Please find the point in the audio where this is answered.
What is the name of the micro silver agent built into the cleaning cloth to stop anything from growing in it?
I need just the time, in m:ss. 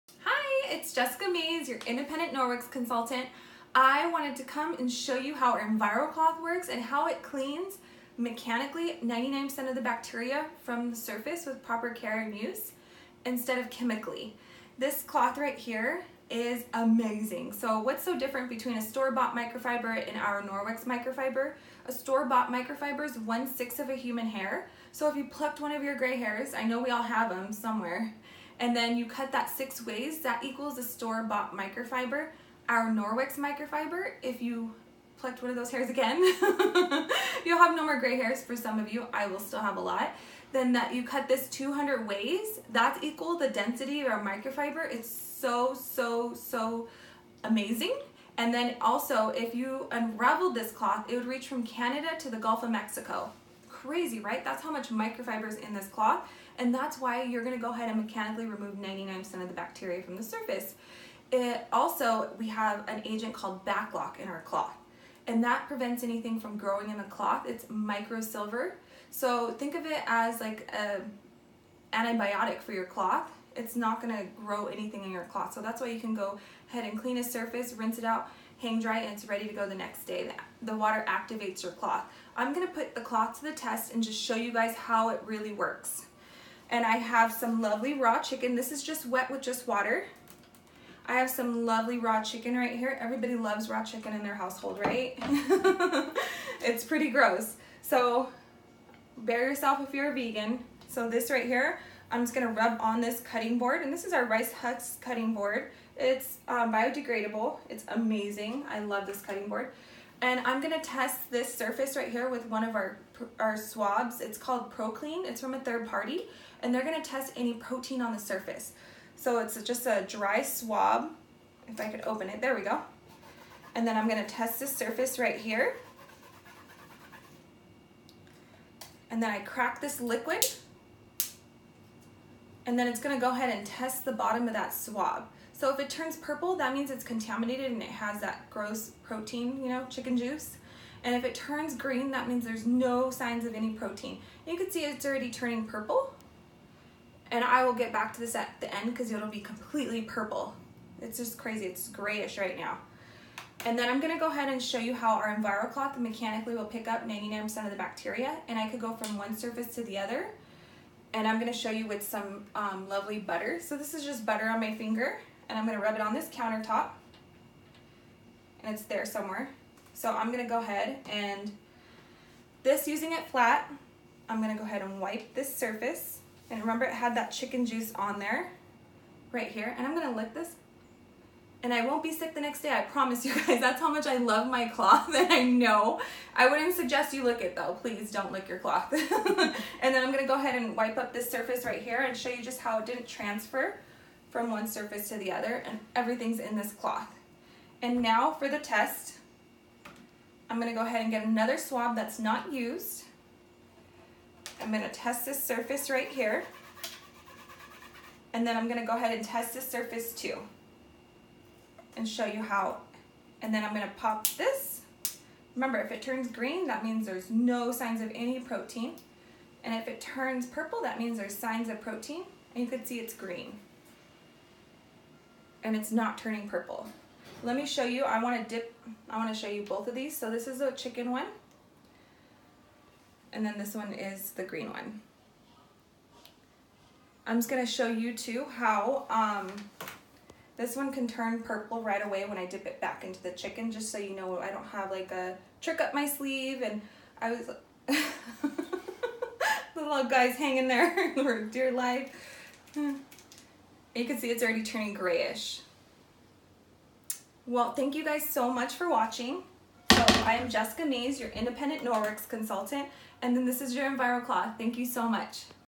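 1:03.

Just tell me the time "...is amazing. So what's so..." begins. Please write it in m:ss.
0:16.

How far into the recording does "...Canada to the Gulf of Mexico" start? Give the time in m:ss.
0:51.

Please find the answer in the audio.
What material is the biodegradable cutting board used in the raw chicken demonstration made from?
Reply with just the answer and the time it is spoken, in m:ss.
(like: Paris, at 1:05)
Rice Husk, at 1:44.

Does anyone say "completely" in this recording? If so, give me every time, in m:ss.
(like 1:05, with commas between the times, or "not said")
2:29.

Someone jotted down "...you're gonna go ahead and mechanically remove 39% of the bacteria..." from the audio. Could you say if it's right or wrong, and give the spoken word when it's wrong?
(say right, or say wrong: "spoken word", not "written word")
wrong: "99", not "39".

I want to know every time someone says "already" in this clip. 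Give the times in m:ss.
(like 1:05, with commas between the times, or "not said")
2:25, 4:14.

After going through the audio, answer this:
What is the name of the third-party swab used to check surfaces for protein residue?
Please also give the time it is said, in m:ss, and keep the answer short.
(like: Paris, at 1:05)
ProClean, at 1:54.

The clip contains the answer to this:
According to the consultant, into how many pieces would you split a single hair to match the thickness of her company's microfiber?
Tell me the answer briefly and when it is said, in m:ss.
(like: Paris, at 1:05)
200, at 0:41.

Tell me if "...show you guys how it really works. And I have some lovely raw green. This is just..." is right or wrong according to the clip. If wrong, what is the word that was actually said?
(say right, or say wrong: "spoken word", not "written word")
wrong: "chicken", not "green".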